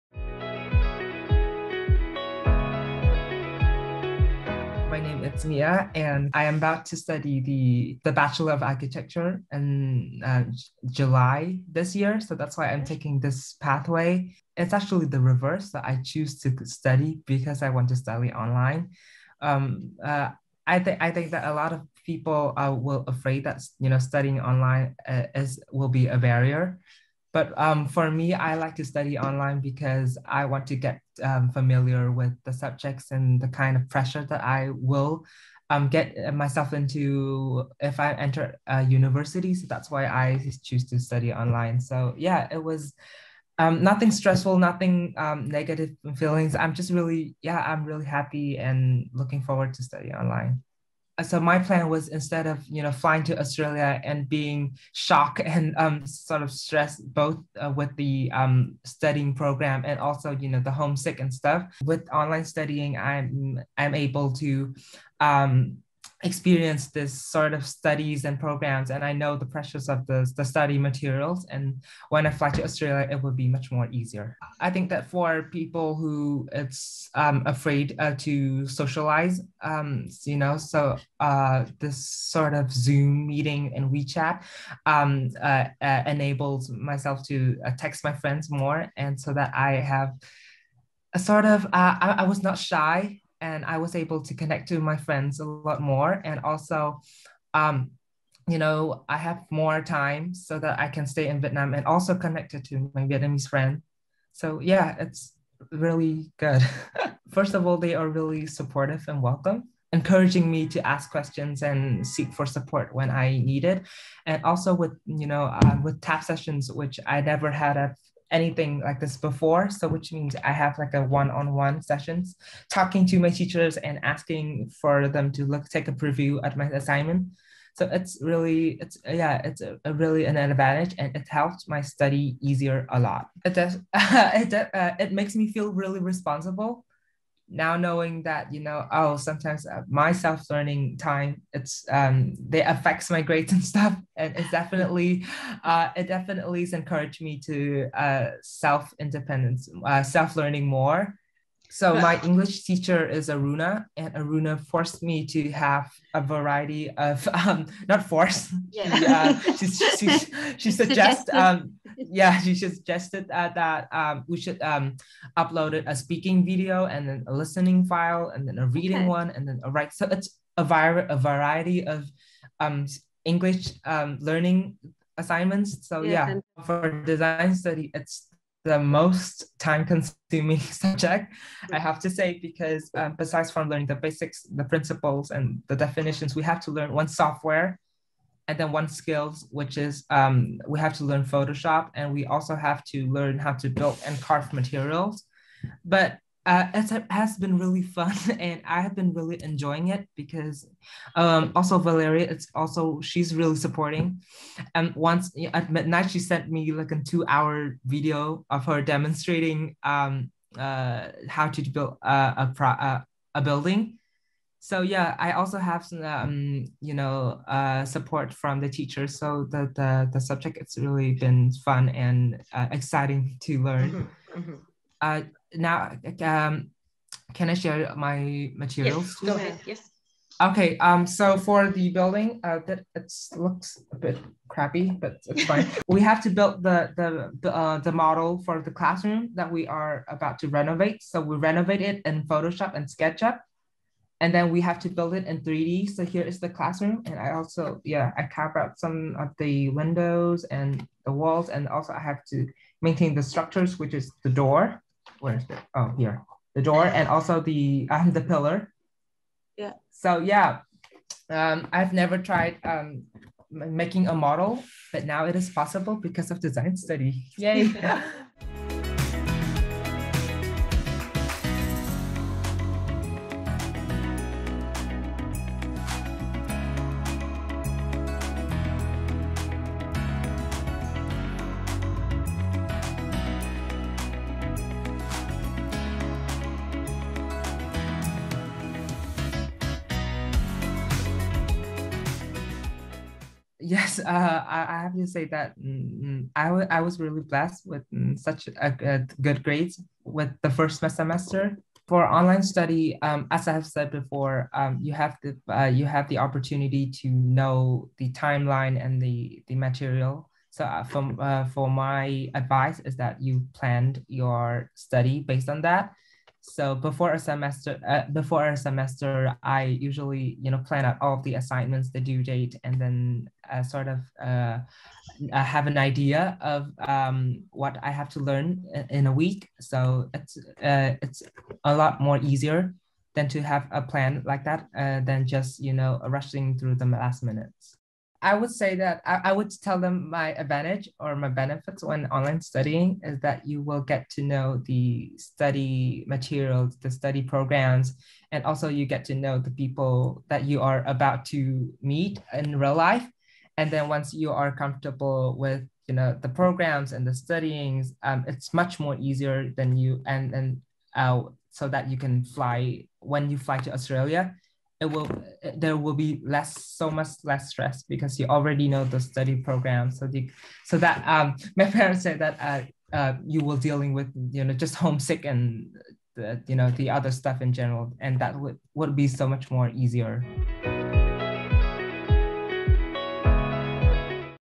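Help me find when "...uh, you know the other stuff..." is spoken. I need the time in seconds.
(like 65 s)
376 s.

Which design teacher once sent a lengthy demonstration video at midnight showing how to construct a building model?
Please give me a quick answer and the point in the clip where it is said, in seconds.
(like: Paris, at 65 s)
Valeria, at 201 s.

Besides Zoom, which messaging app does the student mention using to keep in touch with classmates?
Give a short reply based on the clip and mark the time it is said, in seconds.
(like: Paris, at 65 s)
WeChat, at 83 s.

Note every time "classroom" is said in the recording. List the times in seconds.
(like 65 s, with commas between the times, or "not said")
238 s, 246 s.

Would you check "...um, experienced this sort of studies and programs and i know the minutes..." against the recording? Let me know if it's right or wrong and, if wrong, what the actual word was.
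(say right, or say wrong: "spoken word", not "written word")
wrong: "pressures", not "minutes".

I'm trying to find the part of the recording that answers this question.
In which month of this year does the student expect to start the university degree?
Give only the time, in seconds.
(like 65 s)
10 s.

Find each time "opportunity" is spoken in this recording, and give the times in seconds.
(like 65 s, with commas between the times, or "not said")
306 s.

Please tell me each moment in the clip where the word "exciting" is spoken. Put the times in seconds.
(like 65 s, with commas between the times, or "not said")
222 s.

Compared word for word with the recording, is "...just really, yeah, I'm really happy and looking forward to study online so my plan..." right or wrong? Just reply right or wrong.
right.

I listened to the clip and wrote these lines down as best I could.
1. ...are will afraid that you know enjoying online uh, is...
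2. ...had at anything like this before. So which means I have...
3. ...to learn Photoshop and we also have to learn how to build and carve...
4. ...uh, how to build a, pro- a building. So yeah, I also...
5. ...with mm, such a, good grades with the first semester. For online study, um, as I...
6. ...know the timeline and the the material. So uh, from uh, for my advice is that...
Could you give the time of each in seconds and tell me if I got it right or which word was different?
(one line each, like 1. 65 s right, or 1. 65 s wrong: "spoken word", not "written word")
1. 22 s wrong: "studying", not "enjoying"
2. 117 s right
3. 190 s right
4. 210 s right
5. 297 s right
6. 307 s right.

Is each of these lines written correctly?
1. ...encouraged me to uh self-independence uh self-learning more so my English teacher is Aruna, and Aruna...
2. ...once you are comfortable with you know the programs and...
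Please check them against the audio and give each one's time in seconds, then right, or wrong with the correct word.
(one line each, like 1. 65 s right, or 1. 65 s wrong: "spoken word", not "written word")
1. 146 s right
2. 353 s right.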